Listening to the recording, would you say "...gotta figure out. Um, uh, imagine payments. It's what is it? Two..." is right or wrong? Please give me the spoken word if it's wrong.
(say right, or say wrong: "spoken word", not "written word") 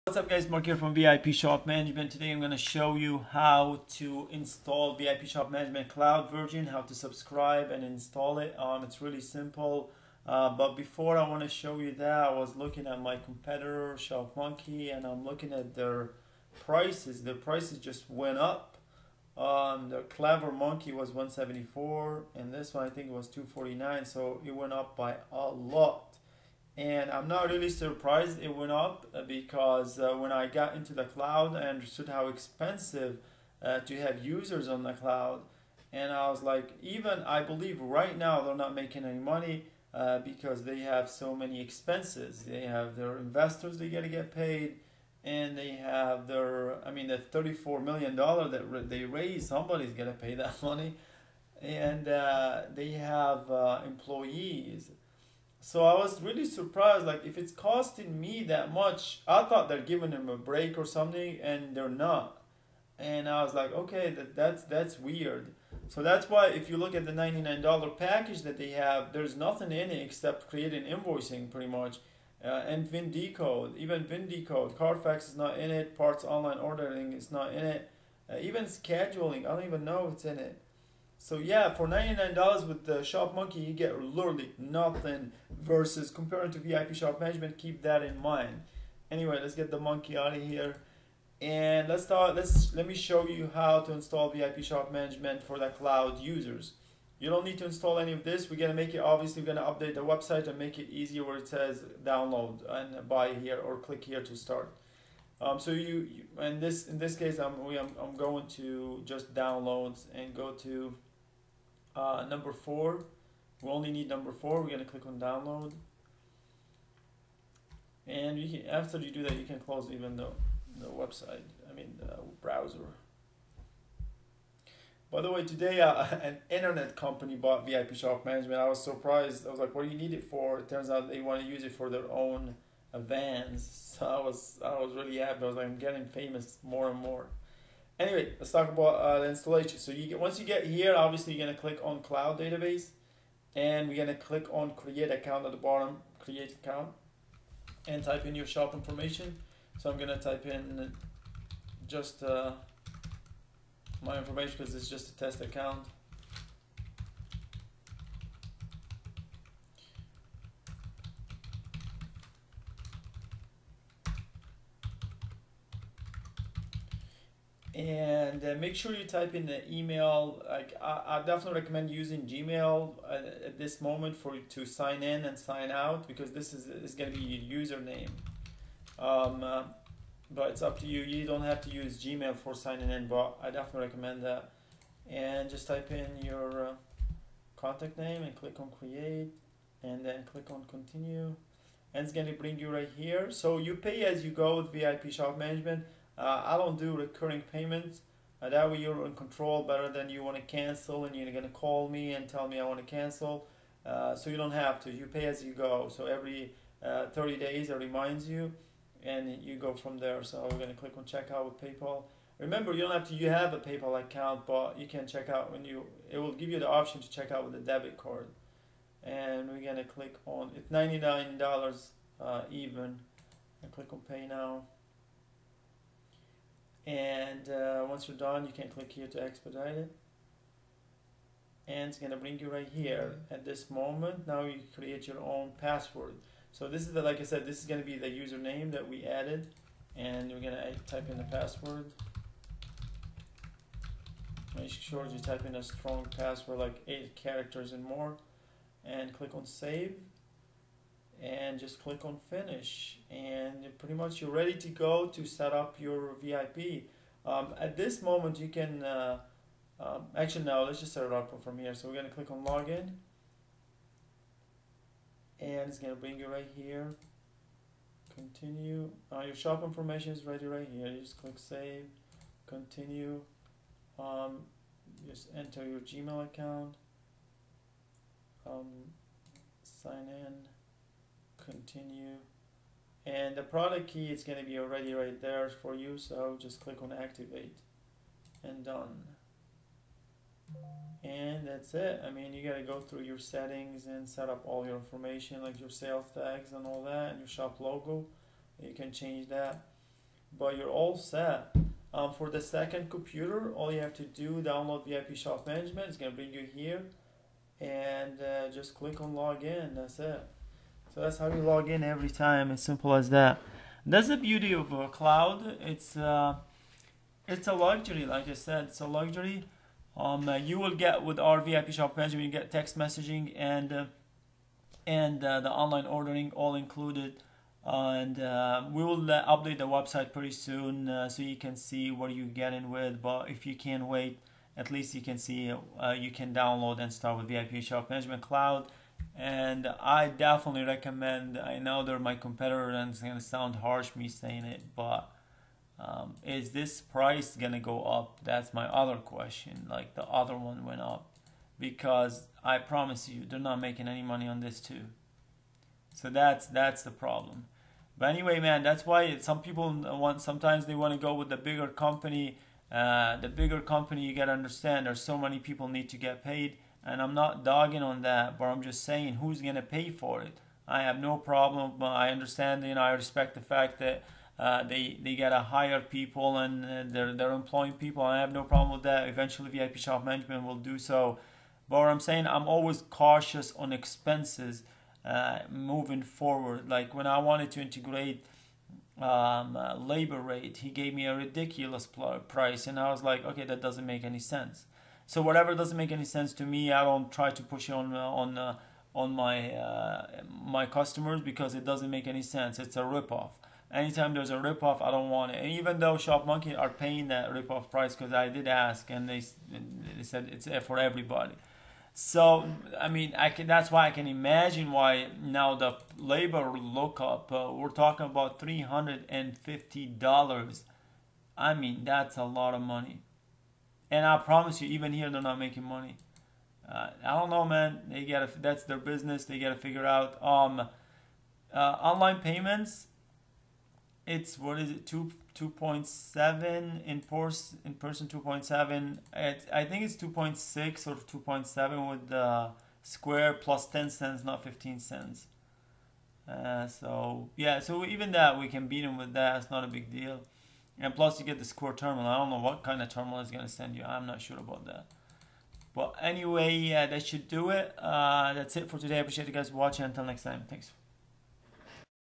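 wrong: "online", not "imagine".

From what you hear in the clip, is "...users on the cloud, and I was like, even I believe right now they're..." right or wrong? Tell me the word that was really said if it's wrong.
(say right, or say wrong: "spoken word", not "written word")
right.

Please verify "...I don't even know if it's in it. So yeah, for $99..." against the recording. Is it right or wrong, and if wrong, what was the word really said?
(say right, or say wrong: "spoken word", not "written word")
right.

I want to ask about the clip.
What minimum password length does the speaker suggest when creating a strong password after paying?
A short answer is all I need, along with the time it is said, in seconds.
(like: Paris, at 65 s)
8 characters, at 246 s.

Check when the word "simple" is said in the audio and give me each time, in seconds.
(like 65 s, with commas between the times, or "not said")
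9 s, 312 s.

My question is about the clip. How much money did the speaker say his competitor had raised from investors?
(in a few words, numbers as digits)
$34 million.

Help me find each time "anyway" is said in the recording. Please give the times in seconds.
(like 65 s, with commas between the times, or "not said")
89 s, 138 s, 358 s, 456 s.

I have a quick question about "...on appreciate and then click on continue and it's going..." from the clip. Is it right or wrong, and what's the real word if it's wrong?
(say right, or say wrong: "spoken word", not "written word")
wrong: "create", not "appreciate".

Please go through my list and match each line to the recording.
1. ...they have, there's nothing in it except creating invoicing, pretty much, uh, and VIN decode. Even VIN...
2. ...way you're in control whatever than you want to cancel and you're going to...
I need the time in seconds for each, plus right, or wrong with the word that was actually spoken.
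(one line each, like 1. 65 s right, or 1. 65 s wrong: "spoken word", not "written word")
1. 68 s right
2. 198 s wrong: "better", not "whatever".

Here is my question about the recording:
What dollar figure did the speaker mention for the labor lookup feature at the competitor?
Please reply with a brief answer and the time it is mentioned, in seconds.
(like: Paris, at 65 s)
$350, at 418 s.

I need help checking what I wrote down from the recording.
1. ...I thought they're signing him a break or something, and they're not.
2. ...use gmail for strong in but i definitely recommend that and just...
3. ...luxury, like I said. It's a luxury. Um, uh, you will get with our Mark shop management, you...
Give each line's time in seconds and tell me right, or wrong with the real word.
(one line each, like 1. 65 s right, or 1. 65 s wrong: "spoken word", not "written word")
1. 59 s wrong: "giving", not "signing"
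2. 181 s wrong: "signing", not "strong"
3. 317 s wrong: "VIP", not "Mark".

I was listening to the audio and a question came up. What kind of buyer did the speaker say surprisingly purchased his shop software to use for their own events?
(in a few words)
An internet company.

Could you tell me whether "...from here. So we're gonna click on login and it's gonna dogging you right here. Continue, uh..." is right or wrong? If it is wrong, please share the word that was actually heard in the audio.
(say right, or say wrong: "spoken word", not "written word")
wrong: "bring", not "dogging".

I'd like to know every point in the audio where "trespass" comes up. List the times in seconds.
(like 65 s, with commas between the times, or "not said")
not said.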